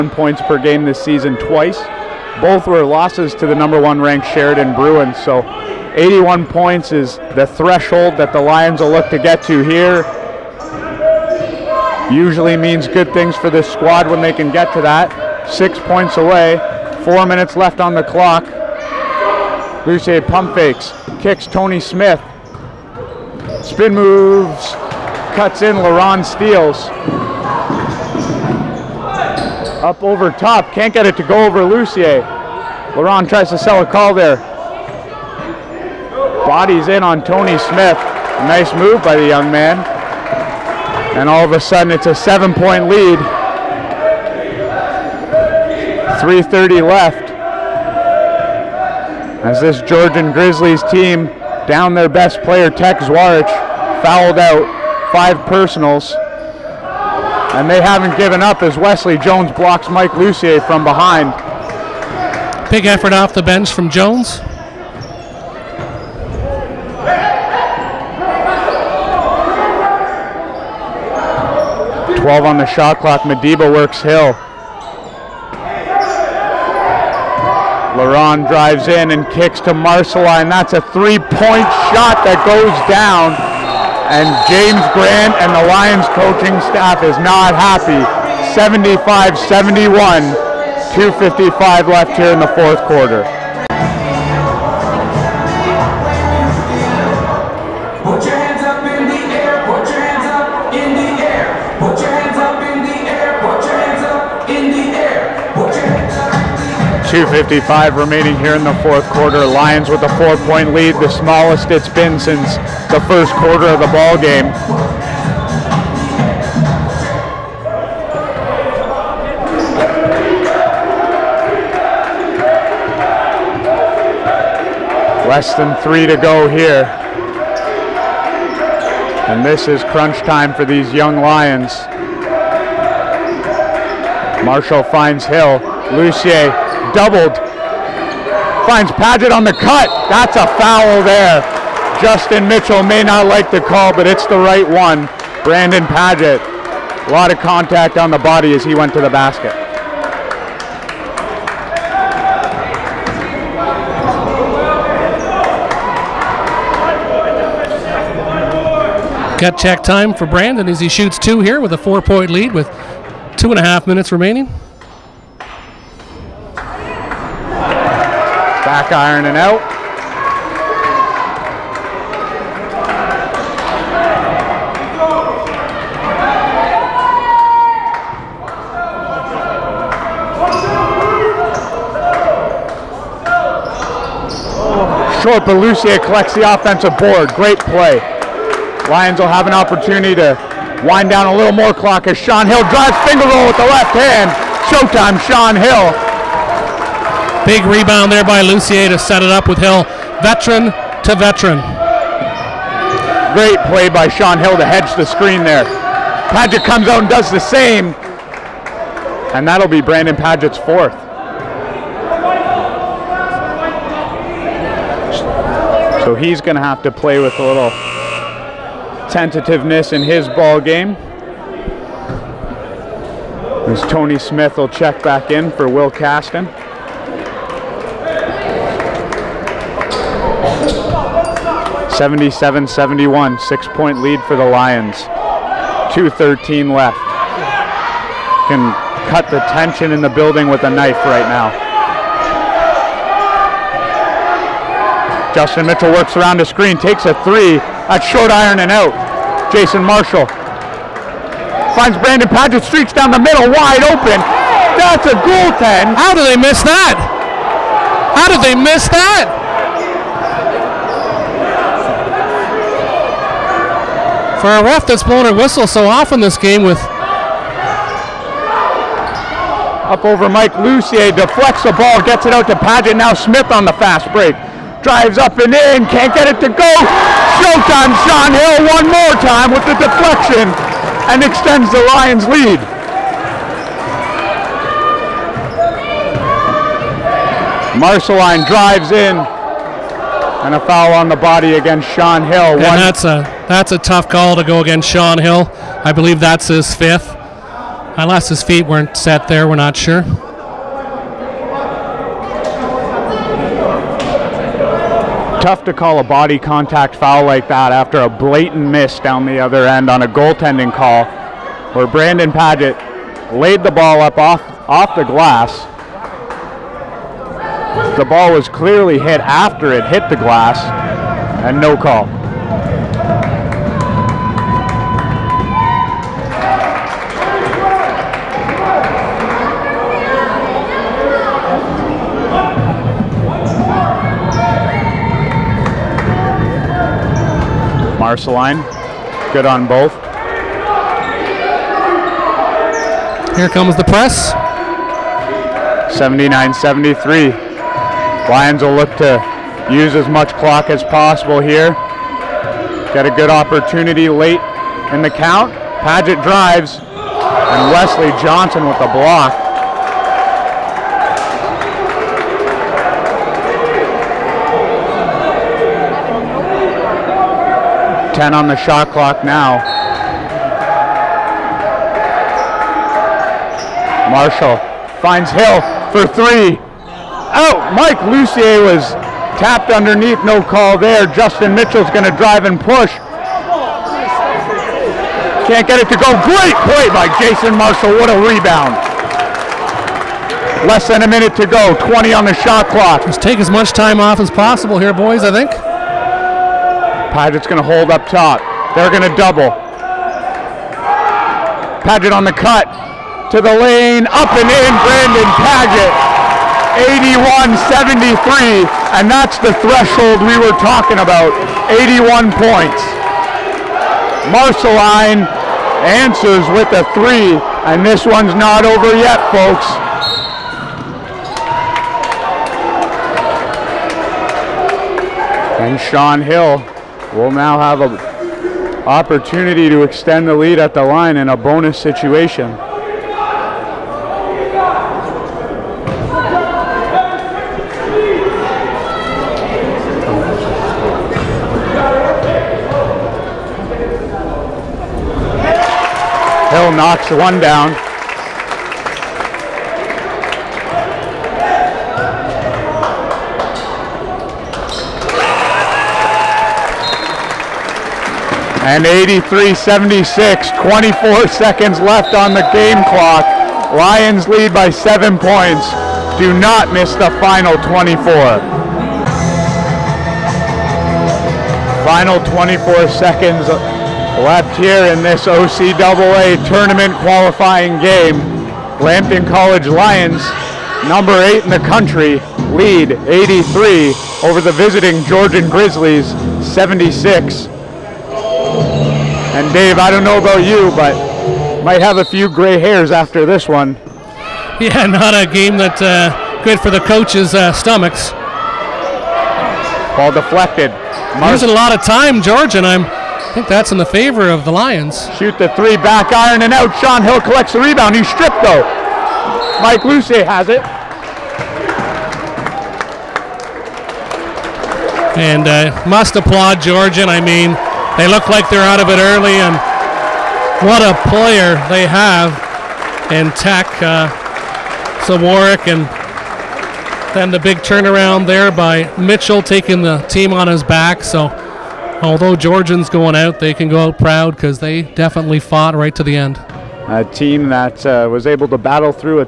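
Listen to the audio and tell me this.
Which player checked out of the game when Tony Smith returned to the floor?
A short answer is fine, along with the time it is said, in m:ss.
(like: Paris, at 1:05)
Will Caston, at 3:45.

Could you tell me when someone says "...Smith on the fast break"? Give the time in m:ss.
4:33.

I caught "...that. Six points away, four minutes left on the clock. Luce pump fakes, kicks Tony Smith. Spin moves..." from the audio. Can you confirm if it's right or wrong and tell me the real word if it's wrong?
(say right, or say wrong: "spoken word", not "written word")
right.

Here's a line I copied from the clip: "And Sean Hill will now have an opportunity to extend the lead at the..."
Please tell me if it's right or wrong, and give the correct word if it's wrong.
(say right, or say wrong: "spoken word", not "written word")
right.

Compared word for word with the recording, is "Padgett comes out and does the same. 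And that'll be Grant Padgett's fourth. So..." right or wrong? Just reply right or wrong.
wrong.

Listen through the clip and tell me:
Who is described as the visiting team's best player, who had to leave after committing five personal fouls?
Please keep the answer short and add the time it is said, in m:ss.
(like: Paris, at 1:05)
Tex Zwarich, at 0:52.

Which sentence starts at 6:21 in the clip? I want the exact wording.
Justin Mitchell's going to drive and push.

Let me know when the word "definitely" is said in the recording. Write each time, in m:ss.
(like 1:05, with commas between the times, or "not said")
8:54.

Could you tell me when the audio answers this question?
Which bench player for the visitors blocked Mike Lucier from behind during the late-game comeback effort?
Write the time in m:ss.
0:58.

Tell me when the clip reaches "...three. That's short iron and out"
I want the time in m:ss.
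4:07.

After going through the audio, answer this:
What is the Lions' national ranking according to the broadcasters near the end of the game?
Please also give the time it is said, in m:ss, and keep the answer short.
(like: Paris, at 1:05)
8, at 8:00.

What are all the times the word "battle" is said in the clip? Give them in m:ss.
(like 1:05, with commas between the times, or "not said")
8:58.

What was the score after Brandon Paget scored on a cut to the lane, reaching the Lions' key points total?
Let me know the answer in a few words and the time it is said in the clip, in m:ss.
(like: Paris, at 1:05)
81-73, at 6:46.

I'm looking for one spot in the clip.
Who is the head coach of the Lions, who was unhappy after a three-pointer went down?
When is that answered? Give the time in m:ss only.
1:24.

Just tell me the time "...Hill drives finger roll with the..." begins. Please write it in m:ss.
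3:12.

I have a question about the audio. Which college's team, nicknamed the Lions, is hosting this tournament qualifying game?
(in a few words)
Lambton College.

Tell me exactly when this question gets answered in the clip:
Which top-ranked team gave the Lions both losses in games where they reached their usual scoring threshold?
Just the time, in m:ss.
0:04.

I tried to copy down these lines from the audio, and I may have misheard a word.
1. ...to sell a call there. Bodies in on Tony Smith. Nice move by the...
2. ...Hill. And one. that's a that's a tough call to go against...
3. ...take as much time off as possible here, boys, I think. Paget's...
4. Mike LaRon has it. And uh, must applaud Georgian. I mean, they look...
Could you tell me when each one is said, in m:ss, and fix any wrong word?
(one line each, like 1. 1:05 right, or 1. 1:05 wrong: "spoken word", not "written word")
1. 0:33 right
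2. 4:52 right
3. 6:33 right
4. 8:29 wrong: "Luce", not "LaRon".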